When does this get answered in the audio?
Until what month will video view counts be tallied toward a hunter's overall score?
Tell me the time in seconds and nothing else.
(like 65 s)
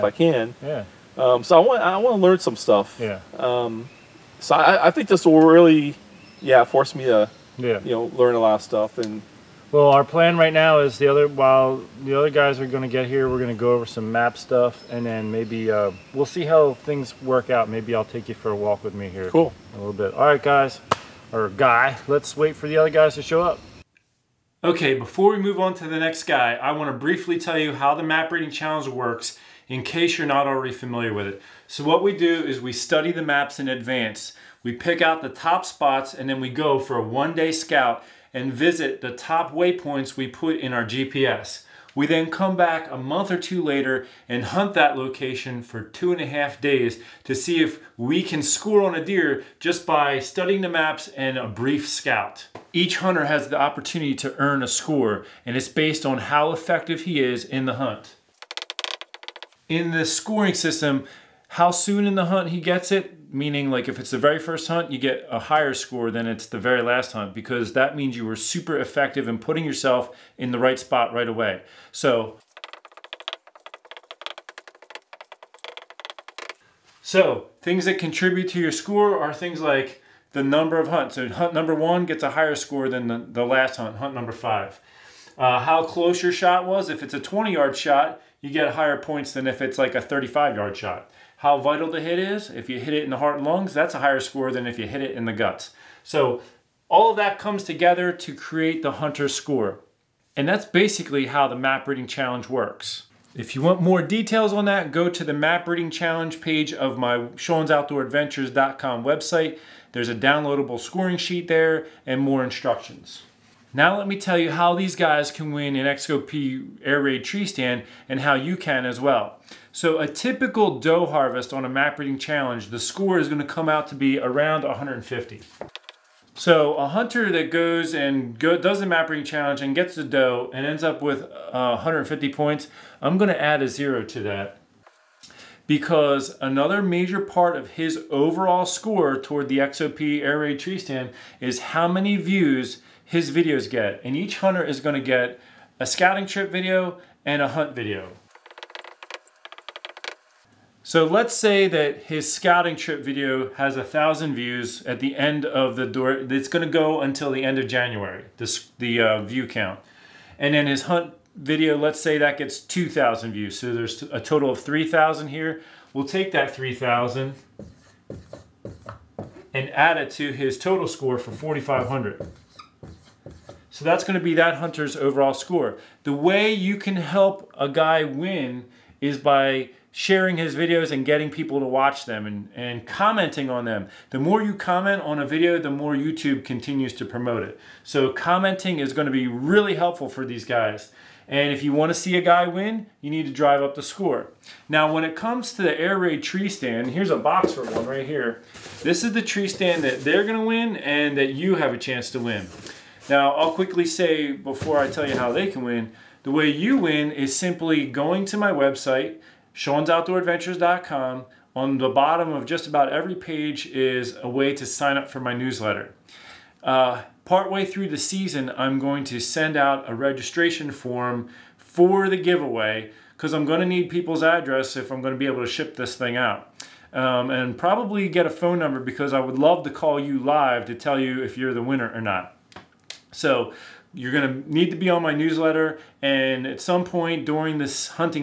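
157 s.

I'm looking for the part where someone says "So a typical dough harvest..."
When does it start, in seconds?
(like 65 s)
119 s.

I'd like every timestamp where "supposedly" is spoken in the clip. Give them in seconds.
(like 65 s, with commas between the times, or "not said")
not said.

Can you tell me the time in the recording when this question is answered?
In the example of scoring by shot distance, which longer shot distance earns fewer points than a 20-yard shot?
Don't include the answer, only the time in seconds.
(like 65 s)
90 s.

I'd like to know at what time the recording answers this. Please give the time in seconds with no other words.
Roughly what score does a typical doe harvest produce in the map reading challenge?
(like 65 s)
124 s.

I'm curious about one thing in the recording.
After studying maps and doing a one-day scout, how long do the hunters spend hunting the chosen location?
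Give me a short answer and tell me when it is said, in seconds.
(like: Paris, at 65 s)
2 and a half days, at 45 s.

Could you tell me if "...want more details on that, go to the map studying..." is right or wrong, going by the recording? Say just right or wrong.
wrong.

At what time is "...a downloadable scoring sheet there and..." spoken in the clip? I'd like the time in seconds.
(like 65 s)
110 s.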